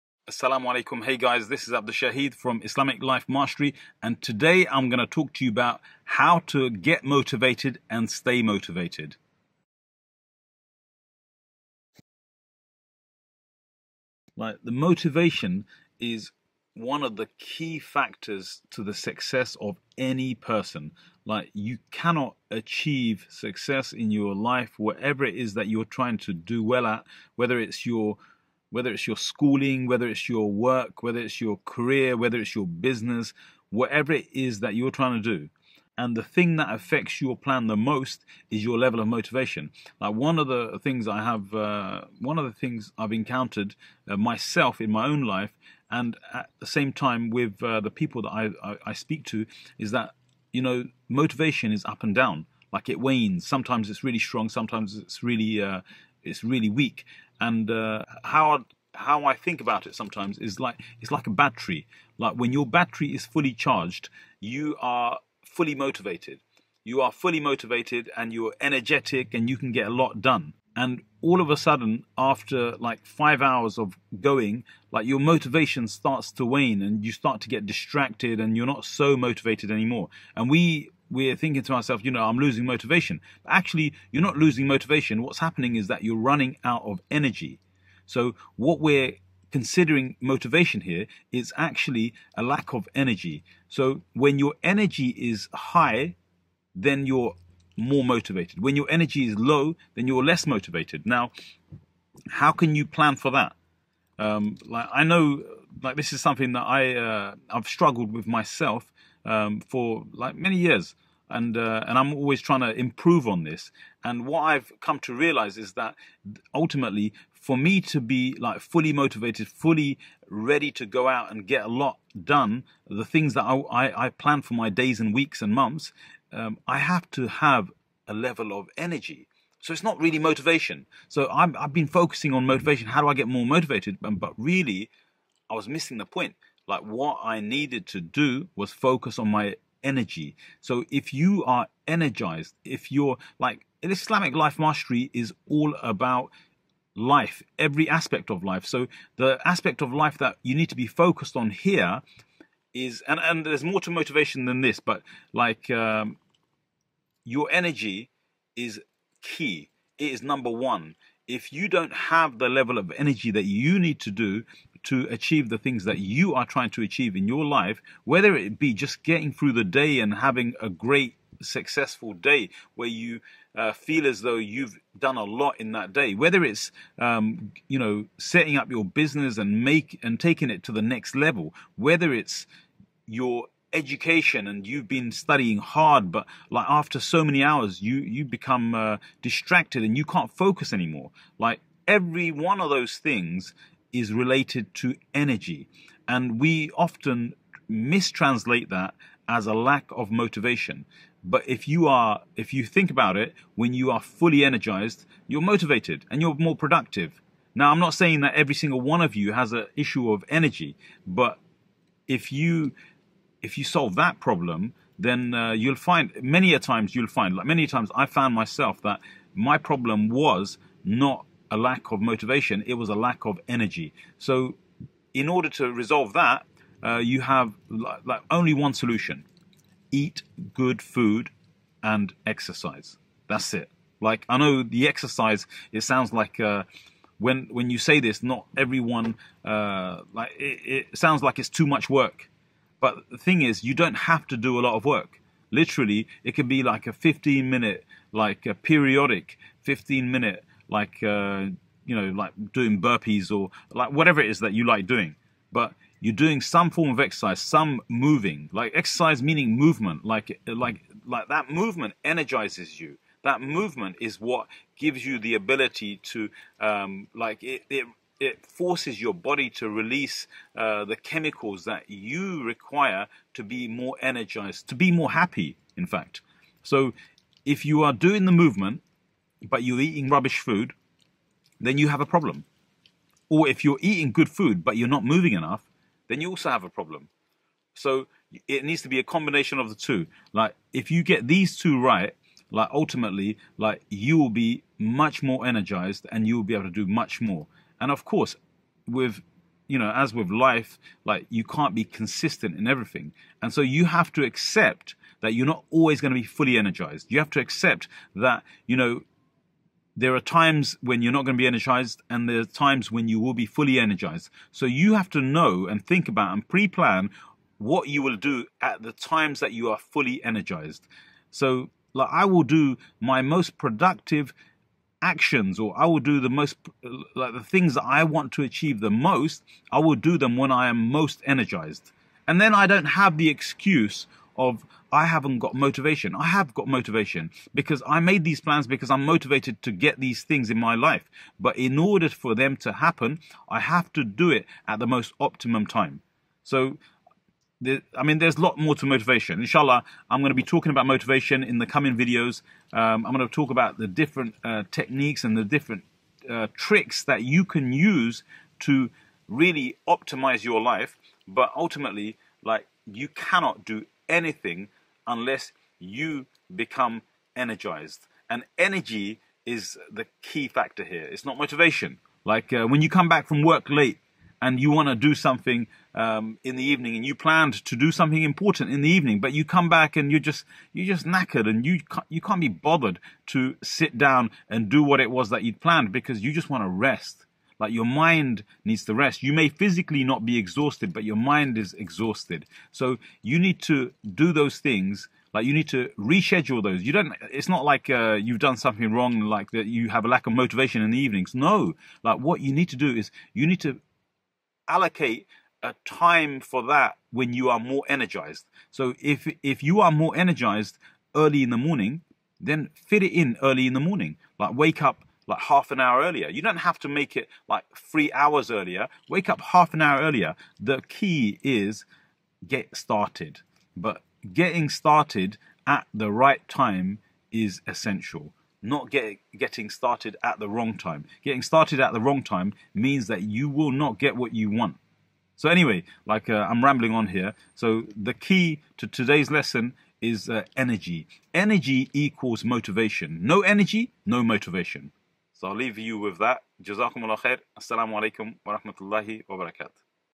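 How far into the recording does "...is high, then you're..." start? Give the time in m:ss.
1:35.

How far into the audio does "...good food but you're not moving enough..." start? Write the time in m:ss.
4:44.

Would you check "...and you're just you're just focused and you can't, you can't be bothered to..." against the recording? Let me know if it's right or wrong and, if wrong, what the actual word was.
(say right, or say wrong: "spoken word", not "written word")
wrong: "knackered", not "focused".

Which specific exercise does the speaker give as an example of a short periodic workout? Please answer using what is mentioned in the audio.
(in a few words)
burpees.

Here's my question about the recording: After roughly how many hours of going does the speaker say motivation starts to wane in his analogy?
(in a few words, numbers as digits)
5.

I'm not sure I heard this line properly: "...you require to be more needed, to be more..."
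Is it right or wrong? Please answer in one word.
wrong.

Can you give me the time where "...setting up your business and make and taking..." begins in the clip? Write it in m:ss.
2:58.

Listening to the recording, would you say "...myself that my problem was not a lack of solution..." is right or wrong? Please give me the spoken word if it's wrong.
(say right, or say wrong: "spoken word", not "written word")
wrong: "motivation", not "solution".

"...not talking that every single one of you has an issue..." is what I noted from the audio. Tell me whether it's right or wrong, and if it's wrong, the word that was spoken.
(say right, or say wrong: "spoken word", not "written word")
wrong: "saying", not "talking".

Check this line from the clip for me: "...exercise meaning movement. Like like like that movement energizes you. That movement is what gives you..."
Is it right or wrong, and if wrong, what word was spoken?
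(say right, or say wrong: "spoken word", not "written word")
right.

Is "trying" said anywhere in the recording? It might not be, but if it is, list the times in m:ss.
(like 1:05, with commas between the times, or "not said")
0:25, 0:34, 1:52, 2:46.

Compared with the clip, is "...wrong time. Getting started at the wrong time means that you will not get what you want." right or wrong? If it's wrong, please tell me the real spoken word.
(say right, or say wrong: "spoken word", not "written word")
right.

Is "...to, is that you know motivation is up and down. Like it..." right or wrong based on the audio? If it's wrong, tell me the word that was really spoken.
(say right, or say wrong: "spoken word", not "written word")
right.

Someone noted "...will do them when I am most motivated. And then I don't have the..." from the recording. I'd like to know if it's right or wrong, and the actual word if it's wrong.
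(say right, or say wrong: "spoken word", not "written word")
wrong: "energized", not "motivated".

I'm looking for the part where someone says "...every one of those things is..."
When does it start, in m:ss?
3:11.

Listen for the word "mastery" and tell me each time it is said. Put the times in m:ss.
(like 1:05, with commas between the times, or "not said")
0:03, 2:24.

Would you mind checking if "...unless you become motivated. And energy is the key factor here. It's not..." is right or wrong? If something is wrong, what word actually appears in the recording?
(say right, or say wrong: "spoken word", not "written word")
wrong: "energized", not "motivated".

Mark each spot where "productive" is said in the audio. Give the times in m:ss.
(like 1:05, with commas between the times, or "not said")
3:26, 5:23.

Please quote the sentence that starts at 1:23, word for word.
But actually, you're not losing motivation.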